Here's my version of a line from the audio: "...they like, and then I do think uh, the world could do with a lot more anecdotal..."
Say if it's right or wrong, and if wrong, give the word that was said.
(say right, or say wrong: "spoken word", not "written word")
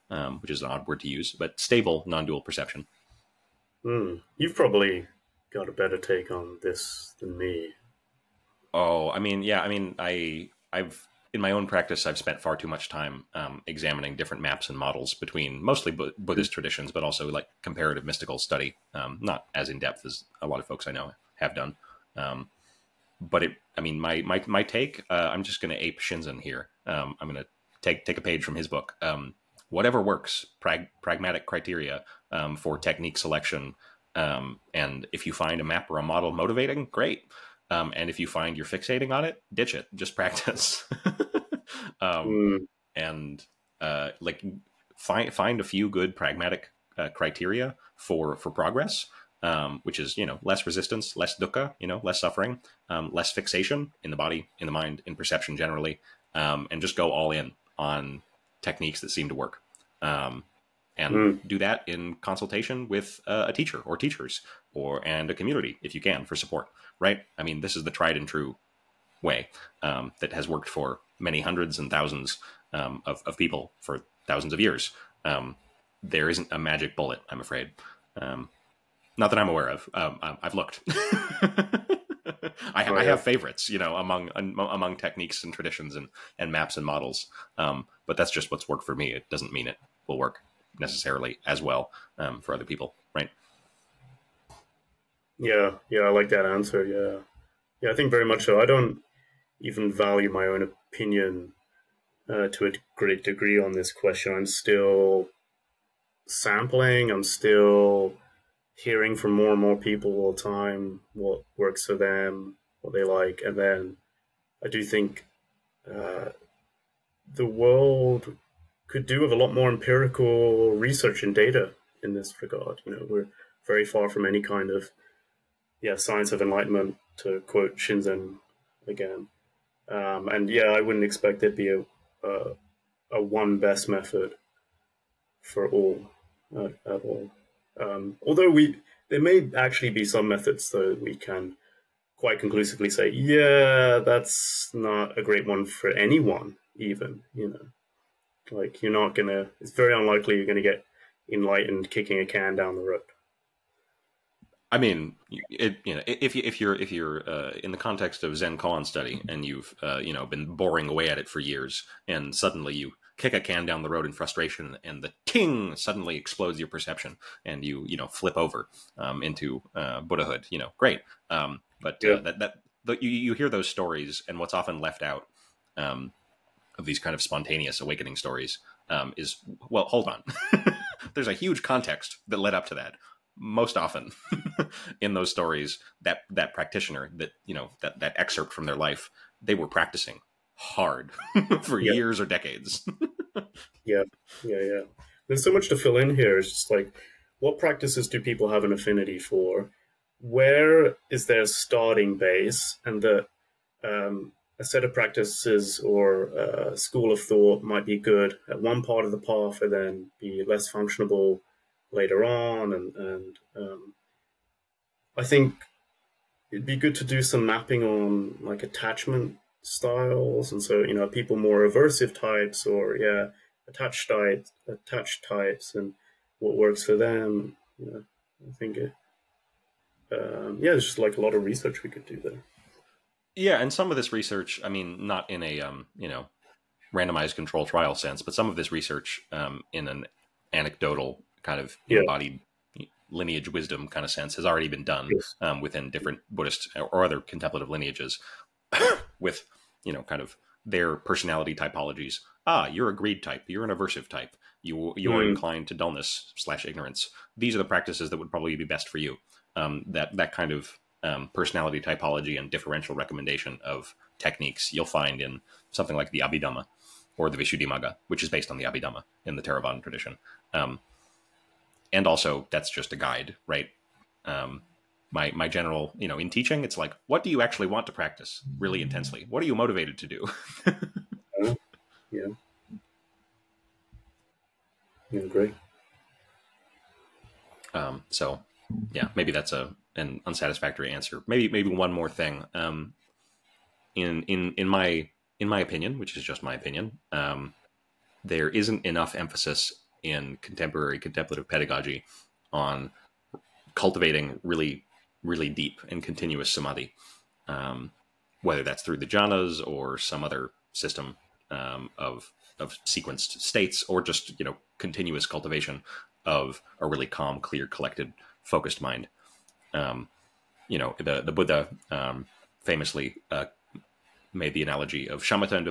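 wrong: "empirical", not "anecdotal".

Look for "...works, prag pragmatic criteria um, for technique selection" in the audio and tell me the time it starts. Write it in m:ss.
0:30.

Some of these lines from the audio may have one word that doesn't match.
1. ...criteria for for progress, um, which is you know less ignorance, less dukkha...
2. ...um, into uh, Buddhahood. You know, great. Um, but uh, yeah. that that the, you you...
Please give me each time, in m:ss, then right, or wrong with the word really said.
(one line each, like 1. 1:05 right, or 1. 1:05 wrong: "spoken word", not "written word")
1. 0:47 wrong: "resistance", not "ignorance"
2. 2:48 right.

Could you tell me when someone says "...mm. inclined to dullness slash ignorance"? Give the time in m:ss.
4:15.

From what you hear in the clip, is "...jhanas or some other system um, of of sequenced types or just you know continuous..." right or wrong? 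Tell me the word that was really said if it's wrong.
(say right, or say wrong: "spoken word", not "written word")
wrong: "states", not "types".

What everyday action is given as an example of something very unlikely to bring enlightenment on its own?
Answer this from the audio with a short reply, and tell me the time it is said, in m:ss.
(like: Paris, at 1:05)
kicking a can, at 2:31.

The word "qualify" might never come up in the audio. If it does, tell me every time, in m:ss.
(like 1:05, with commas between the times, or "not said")
not said.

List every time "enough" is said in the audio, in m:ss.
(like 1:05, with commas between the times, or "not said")
4:58.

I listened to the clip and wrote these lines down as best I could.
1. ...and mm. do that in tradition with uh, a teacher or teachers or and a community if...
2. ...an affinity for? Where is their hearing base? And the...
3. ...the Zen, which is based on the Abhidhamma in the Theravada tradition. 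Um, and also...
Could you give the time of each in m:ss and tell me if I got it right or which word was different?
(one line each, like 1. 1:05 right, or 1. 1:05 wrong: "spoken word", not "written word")
1. 1:00 wrong: "consultation", not "tradition"
2. 3:18 wrong: "starting", not "hearing"
3. 4:27 wrong: "Visuddhimagga", not "Zen".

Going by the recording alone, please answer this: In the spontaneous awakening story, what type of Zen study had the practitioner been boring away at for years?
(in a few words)
koan study.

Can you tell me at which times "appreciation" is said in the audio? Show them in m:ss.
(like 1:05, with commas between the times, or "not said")
not said.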